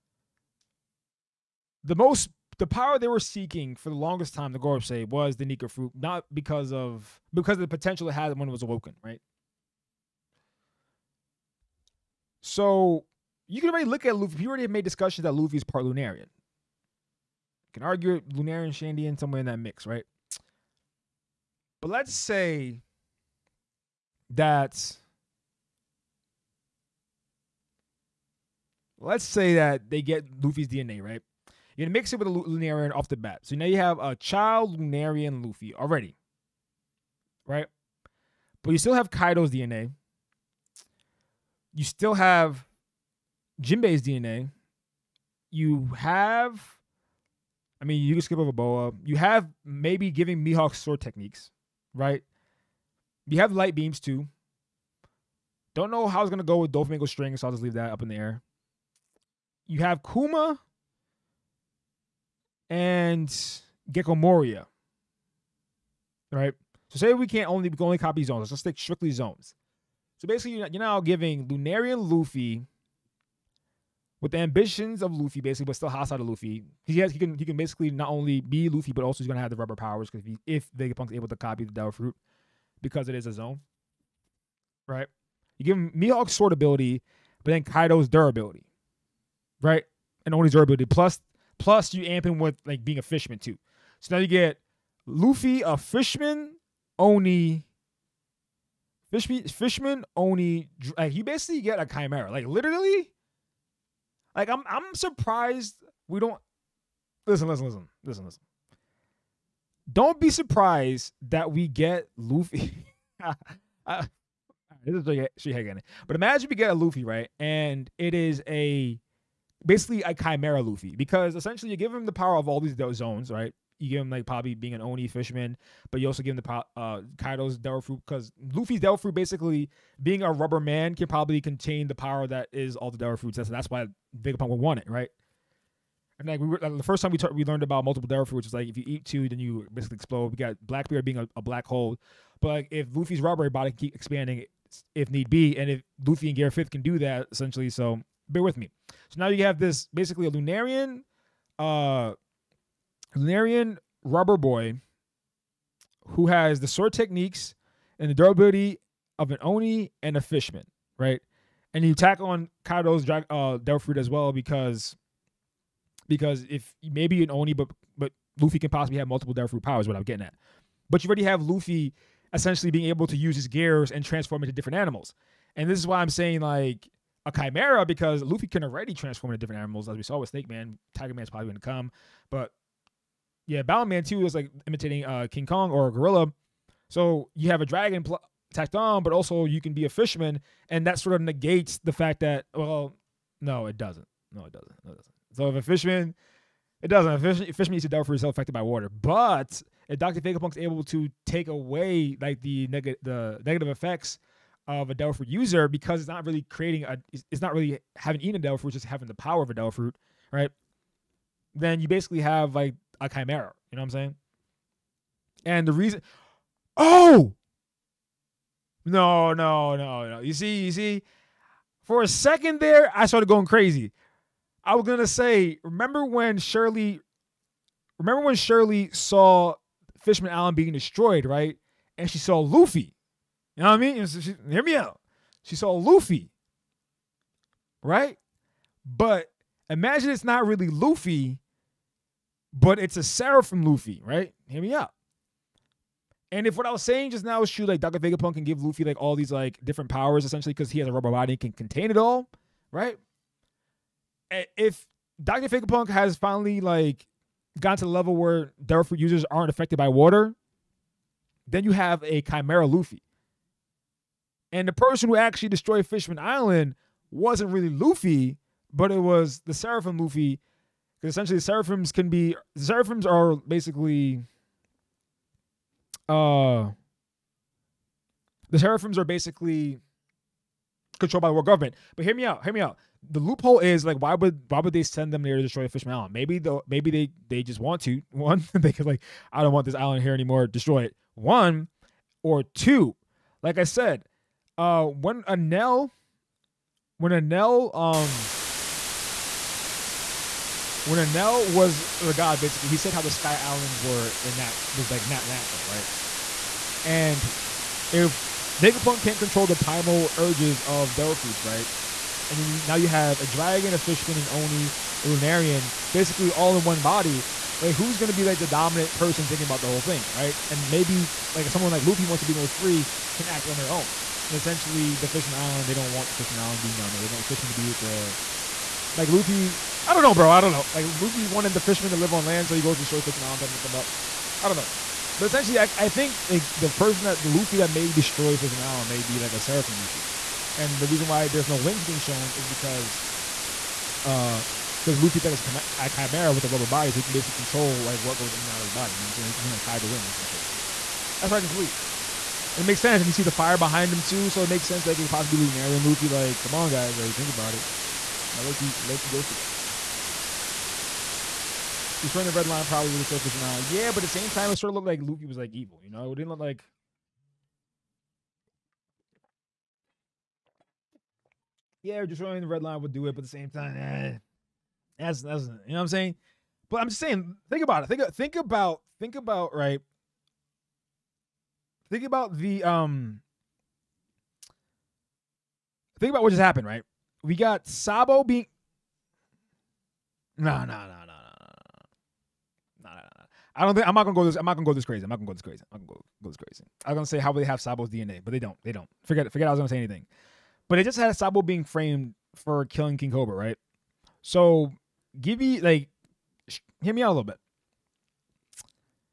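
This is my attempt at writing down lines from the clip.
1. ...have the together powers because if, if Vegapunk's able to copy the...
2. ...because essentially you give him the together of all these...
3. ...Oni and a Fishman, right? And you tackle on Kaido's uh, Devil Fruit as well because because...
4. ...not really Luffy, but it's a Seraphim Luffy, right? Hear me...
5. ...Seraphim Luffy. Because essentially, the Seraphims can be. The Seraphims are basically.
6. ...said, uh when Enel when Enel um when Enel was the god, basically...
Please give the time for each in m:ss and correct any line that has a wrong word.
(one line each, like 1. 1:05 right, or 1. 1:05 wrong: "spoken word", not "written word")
1. 1:19 wrong: "rubber", not "together"
2. 2:00 wrong: "power", not "together"
3. 2:39 right
4. 4:00 right
5. 4:29 right
6. 4:53 right.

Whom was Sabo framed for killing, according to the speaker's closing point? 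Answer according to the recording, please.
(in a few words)
King Cobra.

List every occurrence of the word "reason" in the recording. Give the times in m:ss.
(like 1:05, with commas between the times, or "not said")
3:35, 5:40.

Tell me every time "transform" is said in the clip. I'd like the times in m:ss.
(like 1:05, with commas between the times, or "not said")
2:54, 2:58.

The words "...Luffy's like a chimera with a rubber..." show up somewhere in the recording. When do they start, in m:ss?
5:44.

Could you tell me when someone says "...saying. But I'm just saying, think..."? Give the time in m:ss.
6:15.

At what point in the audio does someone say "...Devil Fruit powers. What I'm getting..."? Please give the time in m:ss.
2:49.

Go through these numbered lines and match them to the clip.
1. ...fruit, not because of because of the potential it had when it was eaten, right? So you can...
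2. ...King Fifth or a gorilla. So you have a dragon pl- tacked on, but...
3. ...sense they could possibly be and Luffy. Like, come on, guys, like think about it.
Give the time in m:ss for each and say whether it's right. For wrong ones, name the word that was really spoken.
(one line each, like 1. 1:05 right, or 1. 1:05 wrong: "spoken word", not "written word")
1. 0:05 wrong: "awoken", not "eaten"
2. 3:05 wrong: "Kong", not "Fifth"
3. 5:54 right.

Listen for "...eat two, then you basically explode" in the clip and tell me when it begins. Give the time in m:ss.
2:18.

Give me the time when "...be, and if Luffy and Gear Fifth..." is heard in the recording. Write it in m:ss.
2:25.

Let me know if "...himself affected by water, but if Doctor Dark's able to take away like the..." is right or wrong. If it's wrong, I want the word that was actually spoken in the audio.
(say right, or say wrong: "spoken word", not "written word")
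wrong: "Vegapunk", not "Dark".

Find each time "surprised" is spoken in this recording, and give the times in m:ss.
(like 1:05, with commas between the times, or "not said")
1:44, 1:50.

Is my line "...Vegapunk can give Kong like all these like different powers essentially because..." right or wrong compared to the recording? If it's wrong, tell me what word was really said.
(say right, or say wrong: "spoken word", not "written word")
wrong: "Luffy", not "Kong".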